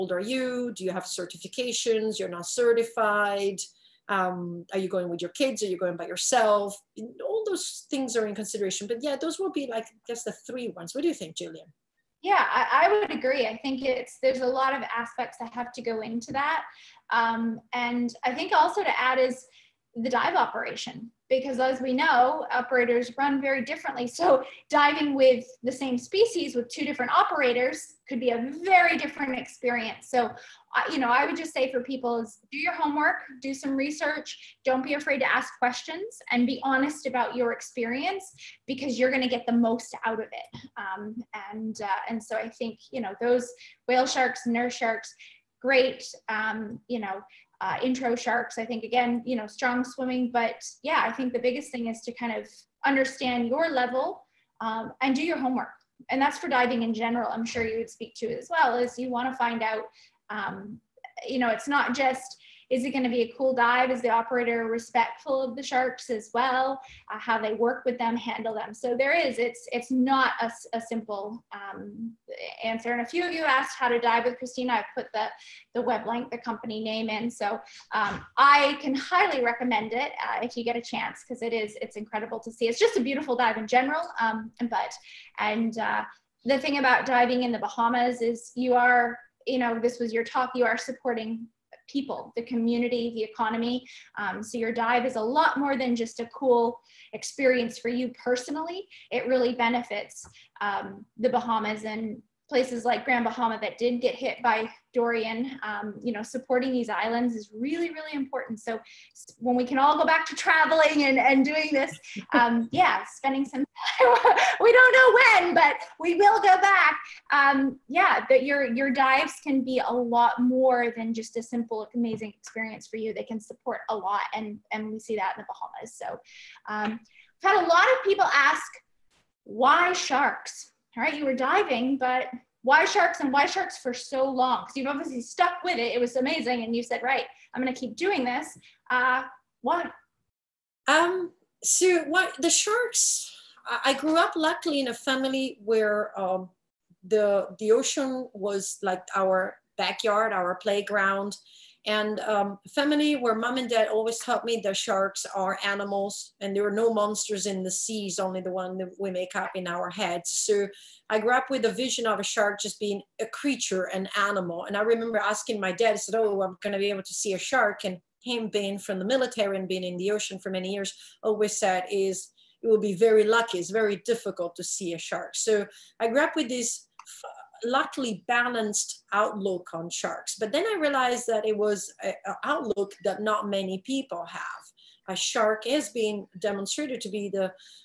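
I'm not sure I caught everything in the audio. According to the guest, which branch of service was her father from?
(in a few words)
The military.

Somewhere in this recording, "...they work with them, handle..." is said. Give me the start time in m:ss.
1:07.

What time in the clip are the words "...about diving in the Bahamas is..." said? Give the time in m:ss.
1:26.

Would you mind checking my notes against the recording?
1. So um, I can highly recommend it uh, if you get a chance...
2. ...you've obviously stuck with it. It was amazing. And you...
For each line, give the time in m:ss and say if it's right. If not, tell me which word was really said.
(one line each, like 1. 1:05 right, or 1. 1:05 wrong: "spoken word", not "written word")
1. 1:17 right
2. 2:14 right.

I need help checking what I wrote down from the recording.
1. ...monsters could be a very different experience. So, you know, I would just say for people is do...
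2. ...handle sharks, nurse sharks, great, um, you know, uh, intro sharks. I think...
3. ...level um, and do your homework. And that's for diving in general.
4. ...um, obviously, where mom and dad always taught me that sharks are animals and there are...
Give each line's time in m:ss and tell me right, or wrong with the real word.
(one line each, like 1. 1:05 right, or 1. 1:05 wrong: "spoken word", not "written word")
1. 0:27 wrong: "operators", not "monsters"
2. 0:43 wrong: "whale", not "handle"
3. 0:53 right
4. 2:32 wrong: "family", not "obviously".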